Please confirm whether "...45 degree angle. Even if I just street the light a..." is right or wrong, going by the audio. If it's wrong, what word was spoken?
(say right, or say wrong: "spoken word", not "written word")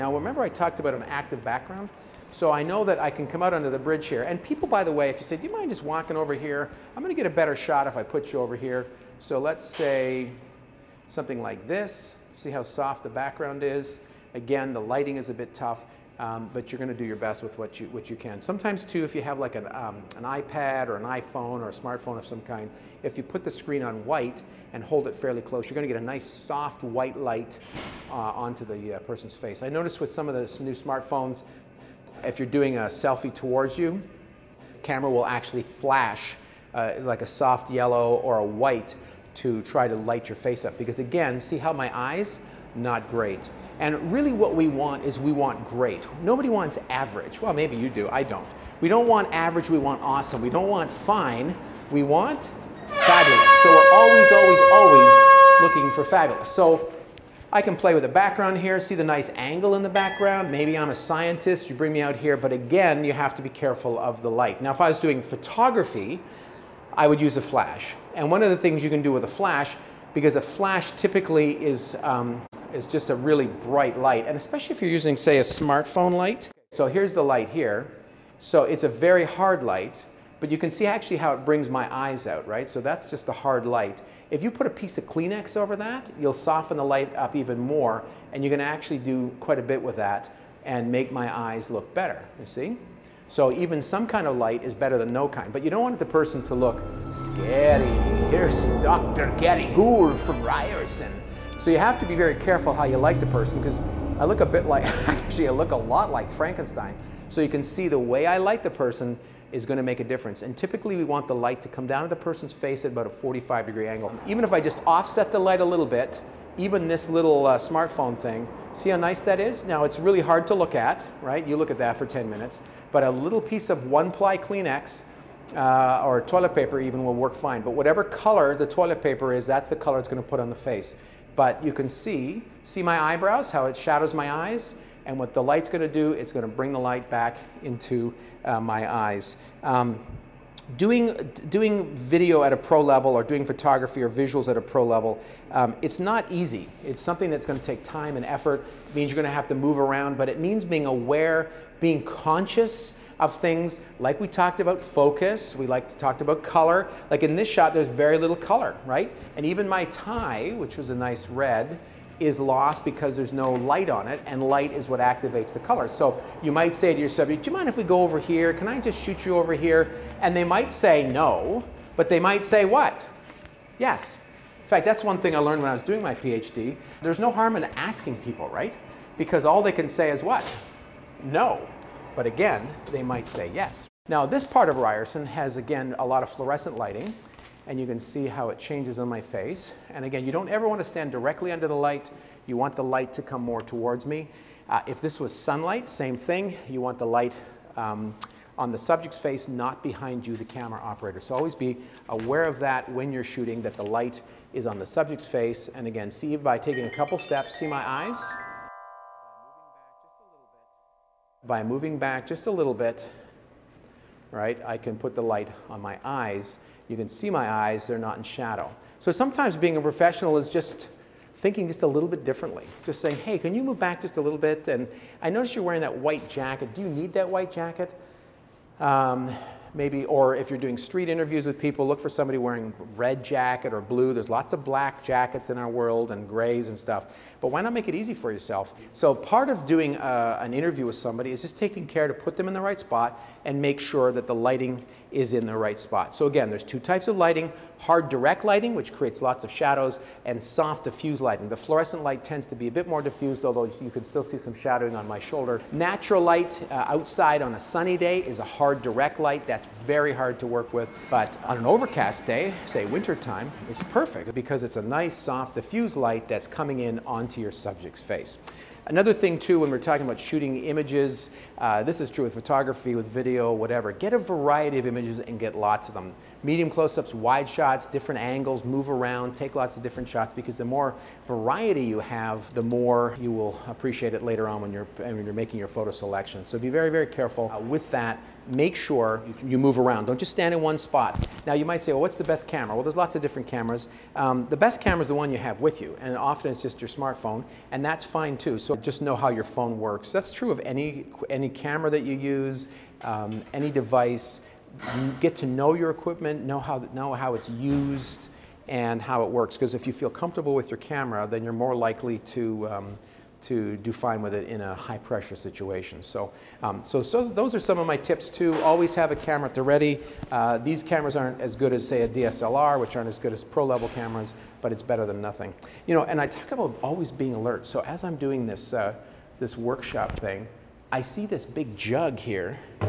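wrong: "offset", not "street".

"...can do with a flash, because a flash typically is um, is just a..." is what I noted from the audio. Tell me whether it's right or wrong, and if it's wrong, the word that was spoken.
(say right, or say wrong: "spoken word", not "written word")
right.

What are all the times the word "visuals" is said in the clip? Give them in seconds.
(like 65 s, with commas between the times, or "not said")
144 s.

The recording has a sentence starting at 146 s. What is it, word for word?
It's something that's gonna take time and effort.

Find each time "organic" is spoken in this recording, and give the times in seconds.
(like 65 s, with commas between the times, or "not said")
not said.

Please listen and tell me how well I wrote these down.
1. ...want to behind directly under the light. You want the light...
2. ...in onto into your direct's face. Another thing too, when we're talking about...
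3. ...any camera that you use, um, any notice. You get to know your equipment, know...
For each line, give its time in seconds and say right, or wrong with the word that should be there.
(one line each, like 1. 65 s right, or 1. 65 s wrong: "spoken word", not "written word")
1. 190 s wrong: "stand", not "behind"
2. 266 s wrong: "subject", not "direct"
3. 301 s wrong: "device", not "notice".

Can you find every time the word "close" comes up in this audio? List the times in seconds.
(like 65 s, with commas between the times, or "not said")
25 s, 276 s.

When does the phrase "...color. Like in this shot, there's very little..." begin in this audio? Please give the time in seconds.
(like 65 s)
156 s.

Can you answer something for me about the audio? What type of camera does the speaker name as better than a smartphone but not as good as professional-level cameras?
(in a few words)
DSLR.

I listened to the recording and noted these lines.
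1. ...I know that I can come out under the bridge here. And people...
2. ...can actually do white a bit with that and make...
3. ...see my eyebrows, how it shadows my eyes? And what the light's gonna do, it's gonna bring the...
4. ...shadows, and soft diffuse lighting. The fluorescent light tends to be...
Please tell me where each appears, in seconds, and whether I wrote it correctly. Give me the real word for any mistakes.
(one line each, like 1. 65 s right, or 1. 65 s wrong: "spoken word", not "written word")
1. 2 s right
2. 88 s wrong: "quite", not "white"
3. 132 s right
4. 249 s right.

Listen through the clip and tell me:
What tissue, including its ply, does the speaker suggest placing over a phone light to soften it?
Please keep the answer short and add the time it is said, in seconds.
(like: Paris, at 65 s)
one ply Kleenex, at 123 s.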